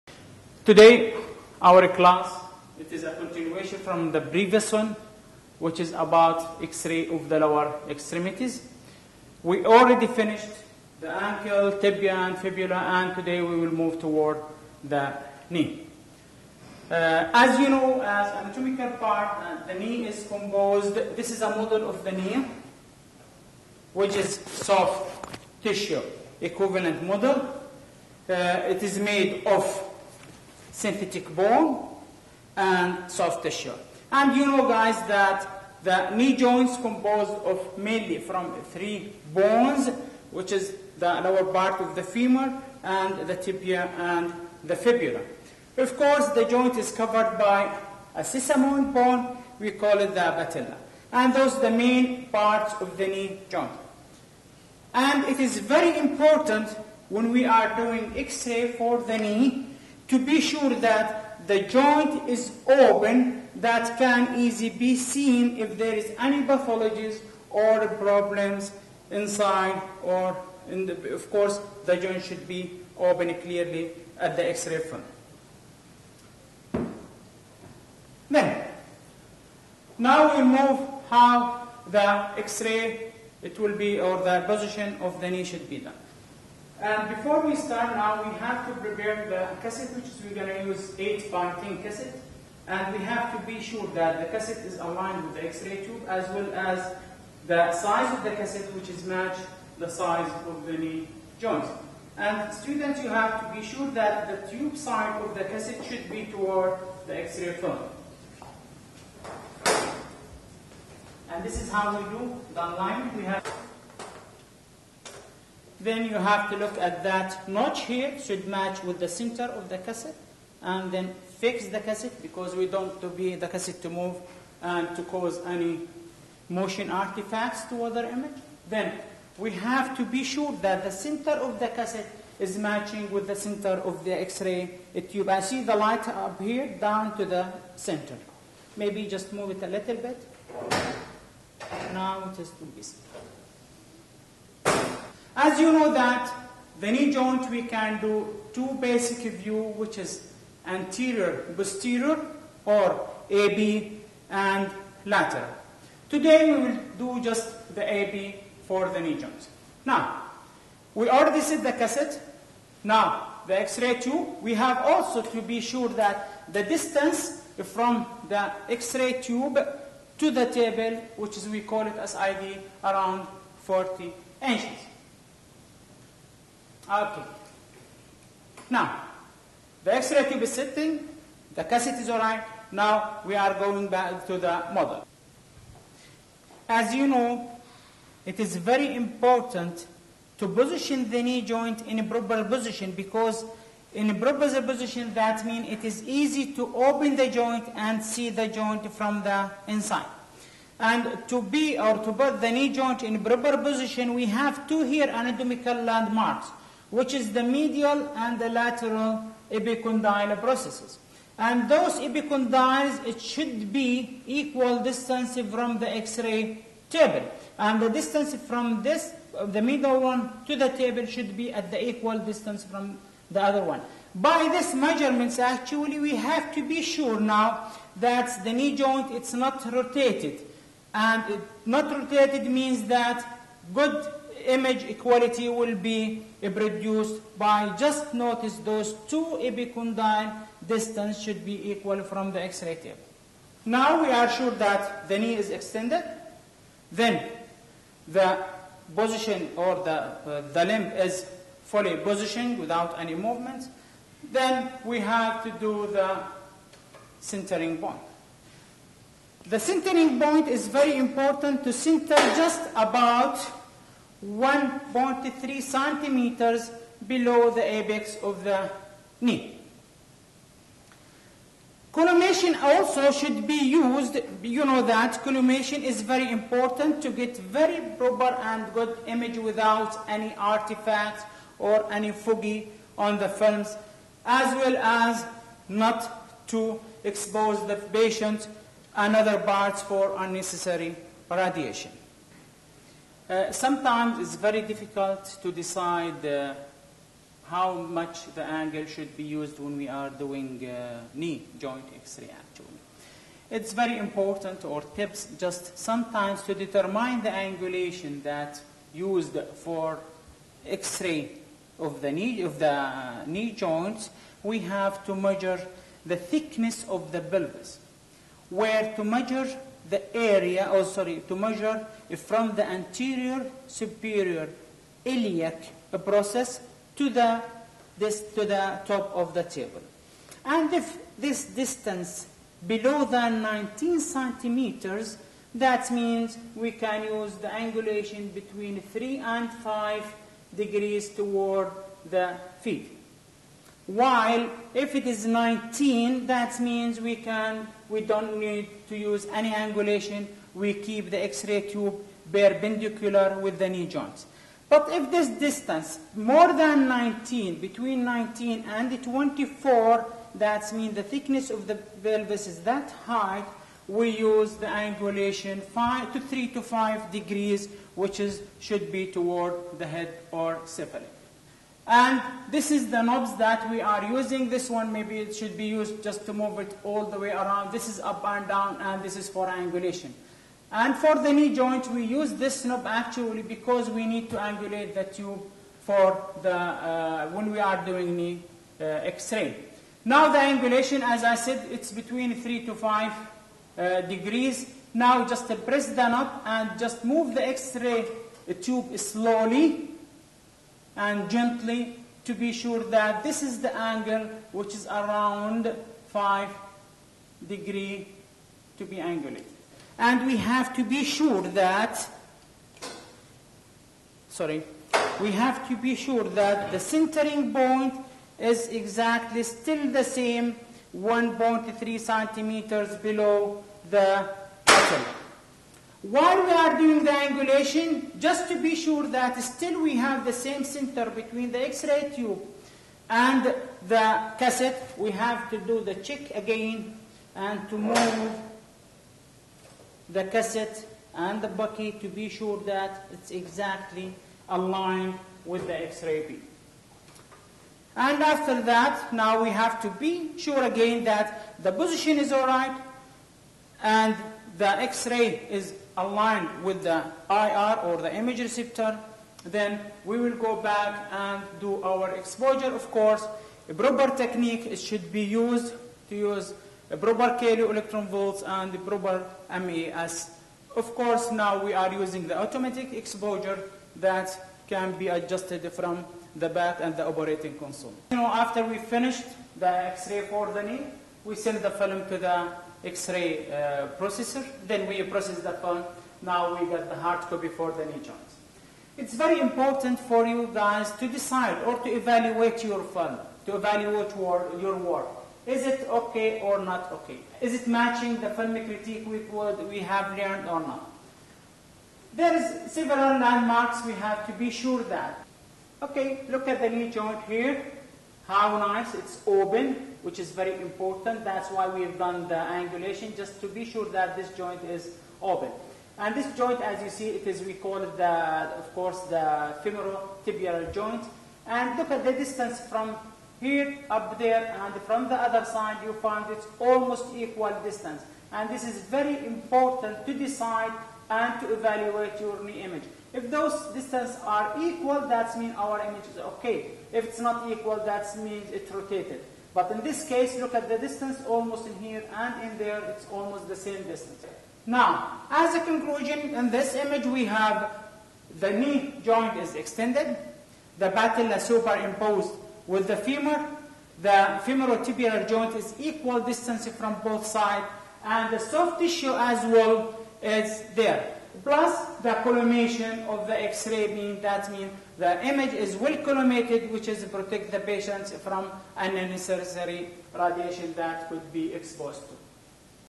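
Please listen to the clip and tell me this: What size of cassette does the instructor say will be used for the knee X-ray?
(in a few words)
8 by 10.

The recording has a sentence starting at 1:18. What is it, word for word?
Then, now we move how the x-ray, it will be, or the position of the knee should be done.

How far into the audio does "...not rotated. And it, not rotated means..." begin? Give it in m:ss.
3:49.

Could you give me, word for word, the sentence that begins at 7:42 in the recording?
Of course, a proper technique it should be used to use a proper kilo electron volts and the proper mAs.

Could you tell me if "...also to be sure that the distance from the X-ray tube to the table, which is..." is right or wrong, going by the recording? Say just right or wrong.
right.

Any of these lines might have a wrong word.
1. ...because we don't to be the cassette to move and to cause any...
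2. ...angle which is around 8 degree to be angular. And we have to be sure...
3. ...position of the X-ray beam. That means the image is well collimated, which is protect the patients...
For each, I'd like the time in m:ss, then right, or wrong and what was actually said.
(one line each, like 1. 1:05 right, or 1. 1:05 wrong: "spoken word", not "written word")
1. 2:02 right
2. 6:43 wrong: "5", not "8"
3. 9:22 wrong: "collimation", not "position".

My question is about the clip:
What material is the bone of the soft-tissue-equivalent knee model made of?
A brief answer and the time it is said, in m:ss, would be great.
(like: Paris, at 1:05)
synthetic bone, at 0:30.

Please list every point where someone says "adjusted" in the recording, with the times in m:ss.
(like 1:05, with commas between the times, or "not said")
7:55.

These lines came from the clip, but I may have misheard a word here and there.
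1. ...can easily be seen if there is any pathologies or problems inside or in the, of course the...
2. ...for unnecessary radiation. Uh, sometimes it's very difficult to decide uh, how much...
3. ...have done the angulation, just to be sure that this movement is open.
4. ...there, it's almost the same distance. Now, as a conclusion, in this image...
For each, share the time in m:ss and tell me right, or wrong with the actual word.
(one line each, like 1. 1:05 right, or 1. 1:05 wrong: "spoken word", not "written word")
1. 1:03 right
2. 4:49 right
3. 8:31 wrong: "joint", not "movement"
4. 9:02 right.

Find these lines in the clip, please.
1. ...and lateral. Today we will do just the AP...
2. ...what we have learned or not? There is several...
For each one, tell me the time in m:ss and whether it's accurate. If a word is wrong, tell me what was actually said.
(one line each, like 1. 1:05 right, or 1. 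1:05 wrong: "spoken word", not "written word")
1. 2:34 right
2. 8:19 right.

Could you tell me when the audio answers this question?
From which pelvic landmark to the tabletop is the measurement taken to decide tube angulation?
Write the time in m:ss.
5:22.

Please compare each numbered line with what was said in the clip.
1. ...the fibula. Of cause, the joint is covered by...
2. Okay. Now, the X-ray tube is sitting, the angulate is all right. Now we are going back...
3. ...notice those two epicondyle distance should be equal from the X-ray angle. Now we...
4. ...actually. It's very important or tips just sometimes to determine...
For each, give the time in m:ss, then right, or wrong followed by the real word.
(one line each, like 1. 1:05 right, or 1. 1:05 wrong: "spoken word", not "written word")
1. 0:44 wrong: "course", not "cause"
2. 2:56 wrong: "cassette", not "angulate"
3. 3:58 wrong: "table", not "angle"
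4. 5:02 right.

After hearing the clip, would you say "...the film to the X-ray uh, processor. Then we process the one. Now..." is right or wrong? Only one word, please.
right.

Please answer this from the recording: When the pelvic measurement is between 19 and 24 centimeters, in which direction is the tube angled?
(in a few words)
cephalic.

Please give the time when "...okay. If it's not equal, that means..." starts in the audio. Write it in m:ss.
8:56.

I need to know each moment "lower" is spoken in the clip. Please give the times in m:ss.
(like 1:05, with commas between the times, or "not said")
0:07, 0:41.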